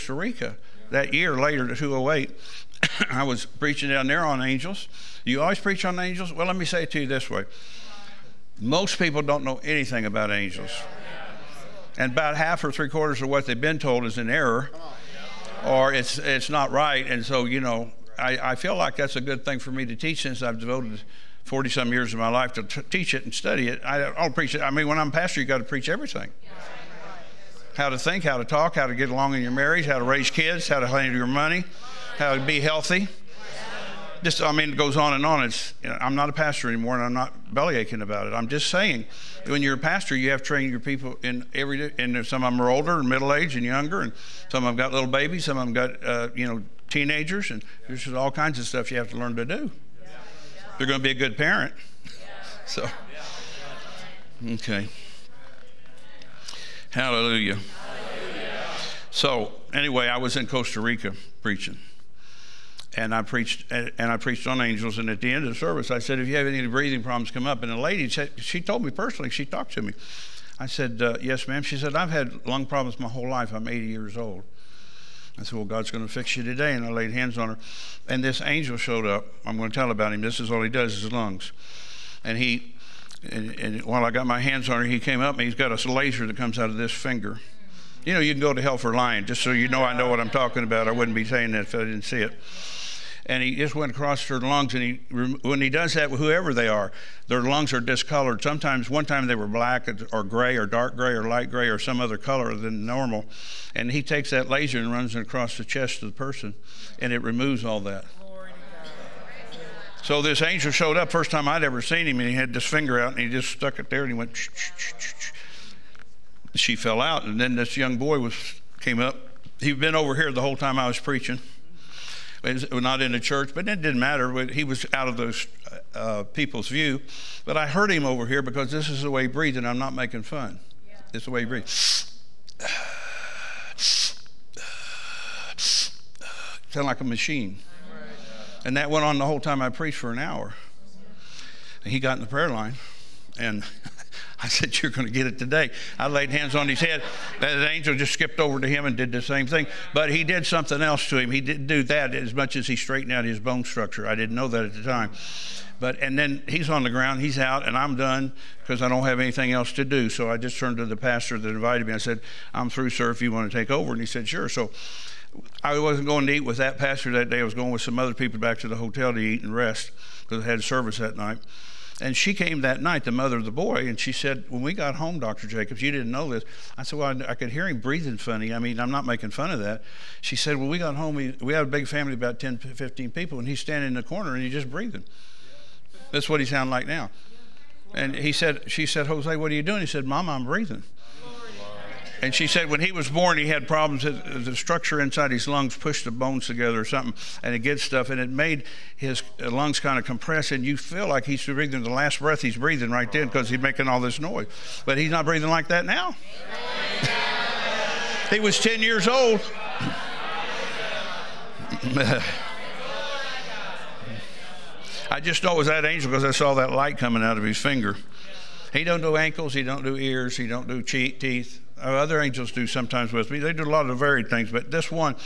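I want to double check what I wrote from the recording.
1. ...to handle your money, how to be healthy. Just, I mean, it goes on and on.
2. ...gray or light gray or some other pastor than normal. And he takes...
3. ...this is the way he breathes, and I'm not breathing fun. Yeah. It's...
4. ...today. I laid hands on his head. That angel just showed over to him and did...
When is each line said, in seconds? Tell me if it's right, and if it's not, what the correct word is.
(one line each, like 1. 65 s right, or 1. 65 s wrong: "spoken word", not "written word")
1. 30 s right
2. 100 s wrong: "color", not "pastor"
3. 128 s wrong: "making", not "breathing"
4. 145 s wrong: "skipped", not "showed".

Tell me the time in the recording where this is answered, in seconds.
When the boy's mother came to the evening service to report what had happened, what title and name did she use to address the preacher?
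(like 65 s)
175 s.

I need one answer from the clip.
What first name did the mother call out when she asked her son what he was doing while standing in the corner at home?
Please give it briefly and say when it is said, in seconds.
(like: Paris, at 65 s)
Jose, at 189 s.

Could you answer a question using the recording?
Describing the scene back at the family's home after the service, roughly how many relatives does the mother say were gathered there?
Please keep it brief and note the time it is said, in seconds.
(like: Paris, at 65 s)
10 to 15, at 182 s.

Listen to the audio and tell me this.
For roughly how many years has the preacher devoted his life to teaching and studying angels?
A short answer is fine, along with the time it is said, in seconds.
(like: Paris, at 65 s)
40 some years, at 21 s.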